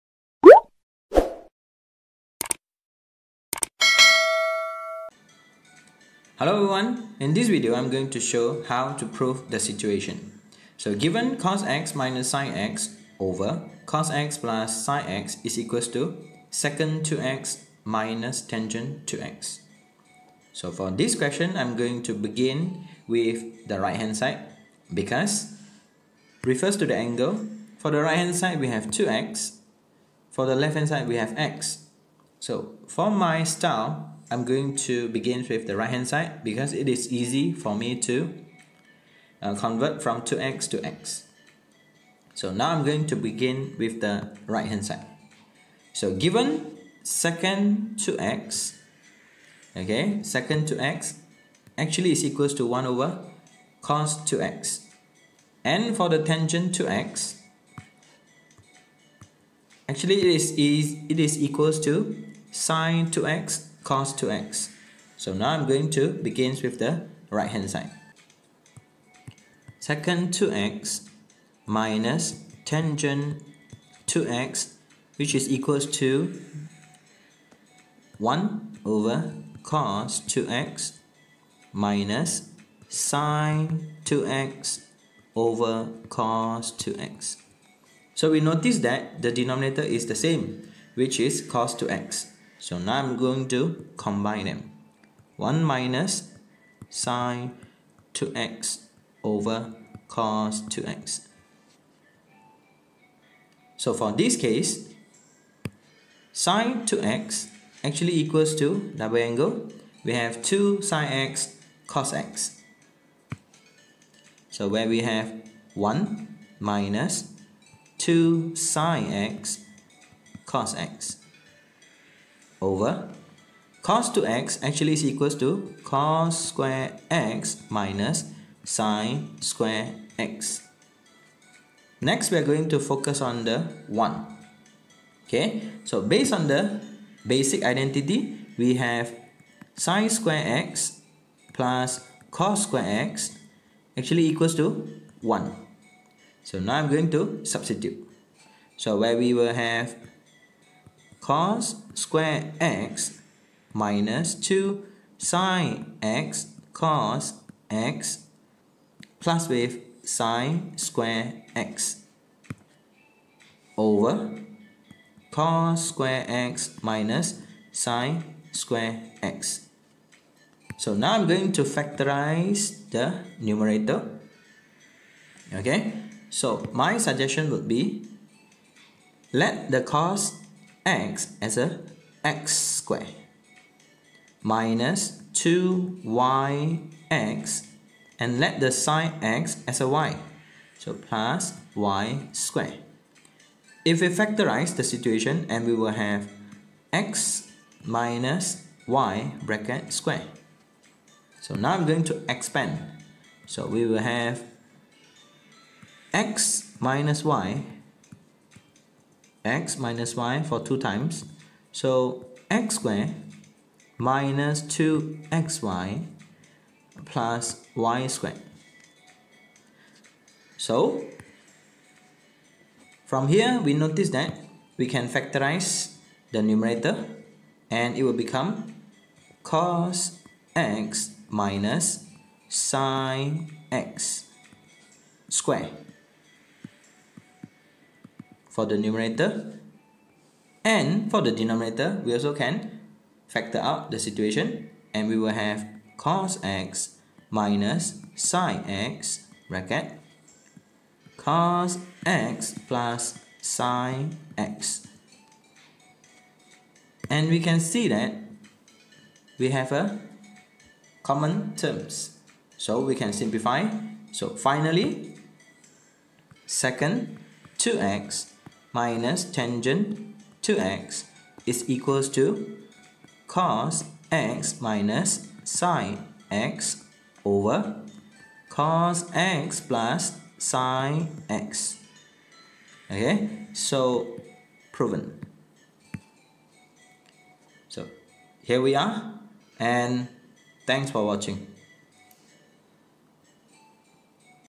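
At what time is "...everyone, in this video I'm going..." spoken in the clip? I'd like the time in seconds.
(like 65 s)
6 s.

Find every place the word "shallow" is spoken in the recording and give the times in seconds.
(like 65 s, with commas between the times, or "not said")
not said.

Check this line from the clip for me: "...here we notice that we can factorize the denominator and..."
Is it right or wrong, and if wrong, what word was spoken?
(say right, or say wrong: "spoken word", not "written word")
wrong: "numerator", not "denominator".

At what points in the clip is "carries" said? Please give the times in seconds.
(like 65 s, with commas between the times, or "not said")
not said.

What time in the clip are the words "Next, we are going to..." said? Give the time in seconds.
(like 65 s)
132 s.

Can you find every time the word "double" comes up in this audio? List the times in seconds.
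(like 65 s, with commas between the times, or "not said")
108 s.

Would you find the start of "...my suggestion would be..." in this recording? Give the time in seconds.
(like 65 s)
176 s.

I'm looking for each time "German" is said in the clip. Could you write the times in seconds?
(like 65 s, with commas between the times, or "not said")
not said.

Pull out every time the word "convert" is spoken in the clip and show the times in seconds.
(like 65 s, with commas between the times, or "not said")
39 s.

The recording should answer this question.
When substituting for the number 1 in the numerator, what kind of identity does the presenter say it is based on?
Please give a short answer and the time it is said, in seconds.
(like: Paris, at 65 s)
basic identity, at 137 s.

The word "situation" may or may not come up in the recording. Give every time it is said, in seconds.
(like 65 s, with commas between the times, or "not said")
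9 s, 194 s, 243 s.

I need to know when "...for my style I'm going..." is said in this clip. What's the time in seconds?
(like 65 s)
32 s.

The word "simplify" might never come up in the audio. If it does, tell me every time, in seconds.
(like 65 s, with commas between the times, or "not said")
263 s.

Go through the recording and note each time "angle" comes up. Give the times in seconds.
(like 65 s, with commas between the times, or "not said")
26 s, 109 s.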